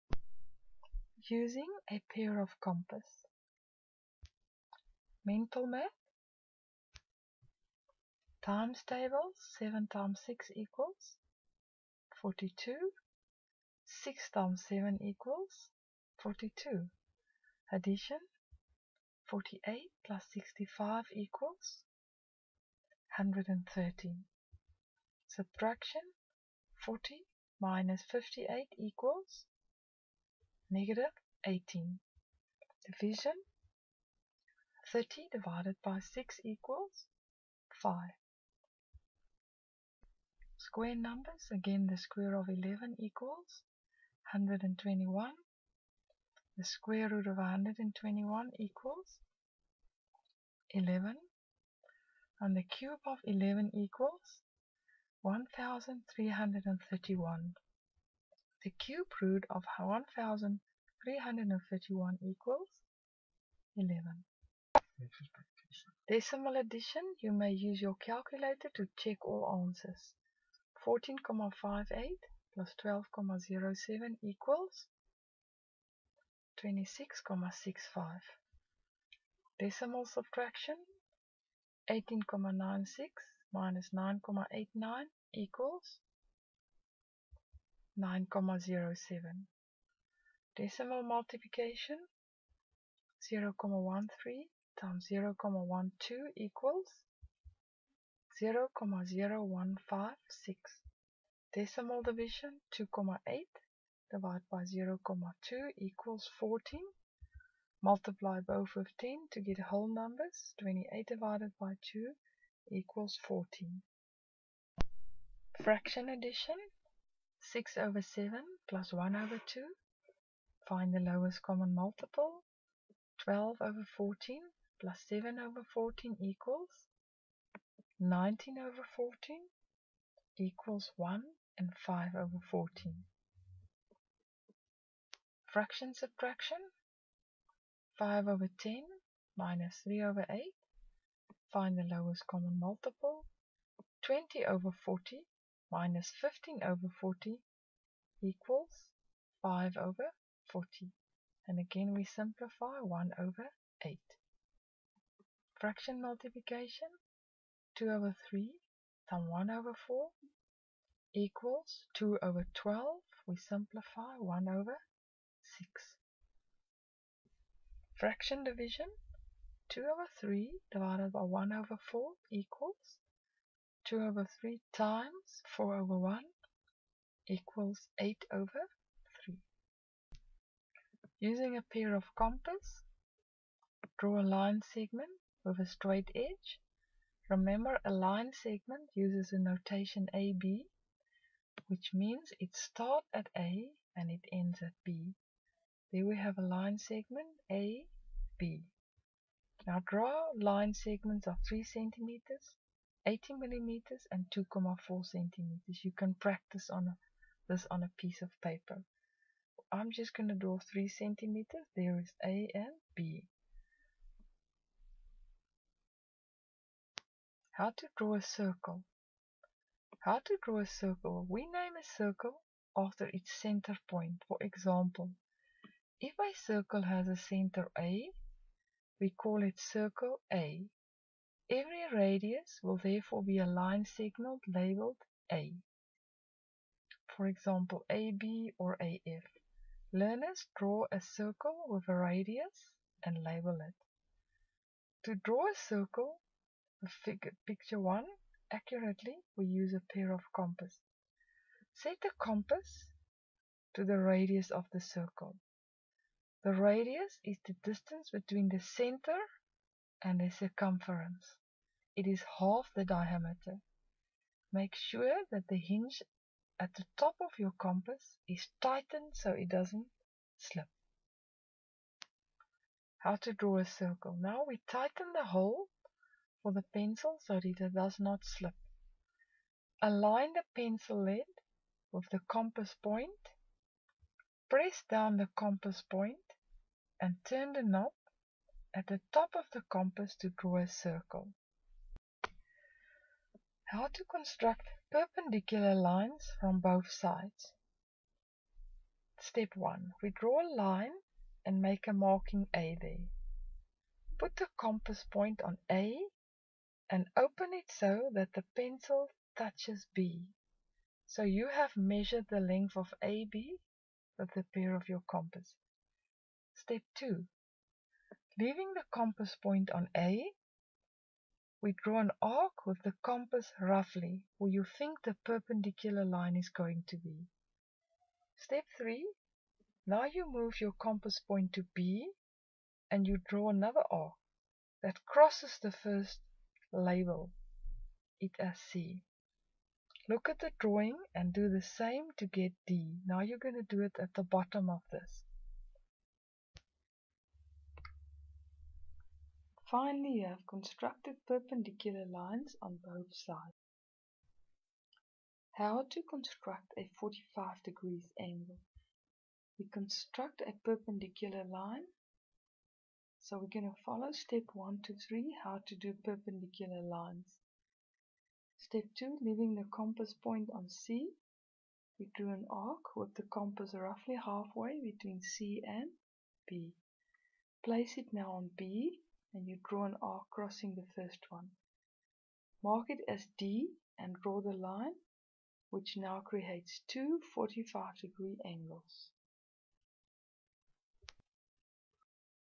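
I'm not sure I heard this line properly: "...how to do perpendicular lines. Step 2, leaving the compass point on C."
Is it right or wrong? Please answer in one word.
right.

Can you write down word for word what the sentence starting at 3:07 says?
Remember a line segment uses a notation AB, which means it starts at A and it ends at B.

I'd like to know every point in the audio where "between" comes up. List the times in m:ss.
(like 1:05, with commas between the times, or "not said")
4:18, 6:14.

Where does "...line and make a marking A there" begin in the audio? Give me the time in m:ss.
5:00.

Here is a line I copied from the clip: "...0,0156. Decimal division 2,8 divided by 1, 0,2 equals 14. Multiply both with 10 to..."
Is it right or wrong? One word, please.
wrong.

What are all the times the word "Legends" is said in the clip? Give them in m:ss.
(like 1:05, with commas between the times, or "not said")
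not said.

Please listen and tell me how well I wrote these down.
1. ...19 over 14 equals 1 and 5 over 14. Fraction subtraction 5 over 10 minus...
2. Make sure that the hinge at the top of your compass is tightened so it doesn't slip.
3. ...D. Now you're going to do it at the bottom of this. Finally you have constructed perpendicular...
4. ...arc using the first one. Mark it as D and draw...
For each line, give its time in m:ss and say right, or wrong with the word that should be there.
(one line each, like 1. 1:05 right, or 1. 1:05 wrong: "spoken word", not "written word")
1. 2:07 right
2. 4:24 right
3. 5:42 right
4. 6:20 wrong: "crossing", not "using".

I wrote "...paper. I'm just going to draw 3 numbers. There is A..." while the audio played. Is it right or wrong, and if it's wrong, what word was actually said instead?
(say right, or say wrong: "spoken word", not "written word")
wrong: "centimeters", not "numbers".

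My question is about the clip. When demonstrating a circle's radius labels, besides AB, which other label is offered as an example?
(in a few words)
AF.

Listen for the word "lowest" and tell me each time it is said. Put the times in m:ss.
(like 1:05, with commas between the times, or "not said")
2:00, 2:21.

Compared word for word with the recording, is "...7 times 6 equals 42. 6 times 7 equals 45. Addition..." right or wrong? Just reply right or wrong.
wrong.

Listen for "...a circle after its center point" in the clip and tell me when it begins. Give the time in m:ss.
3:41.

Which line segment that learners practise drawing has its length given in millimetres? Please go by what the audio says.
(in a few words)
80 millimeters.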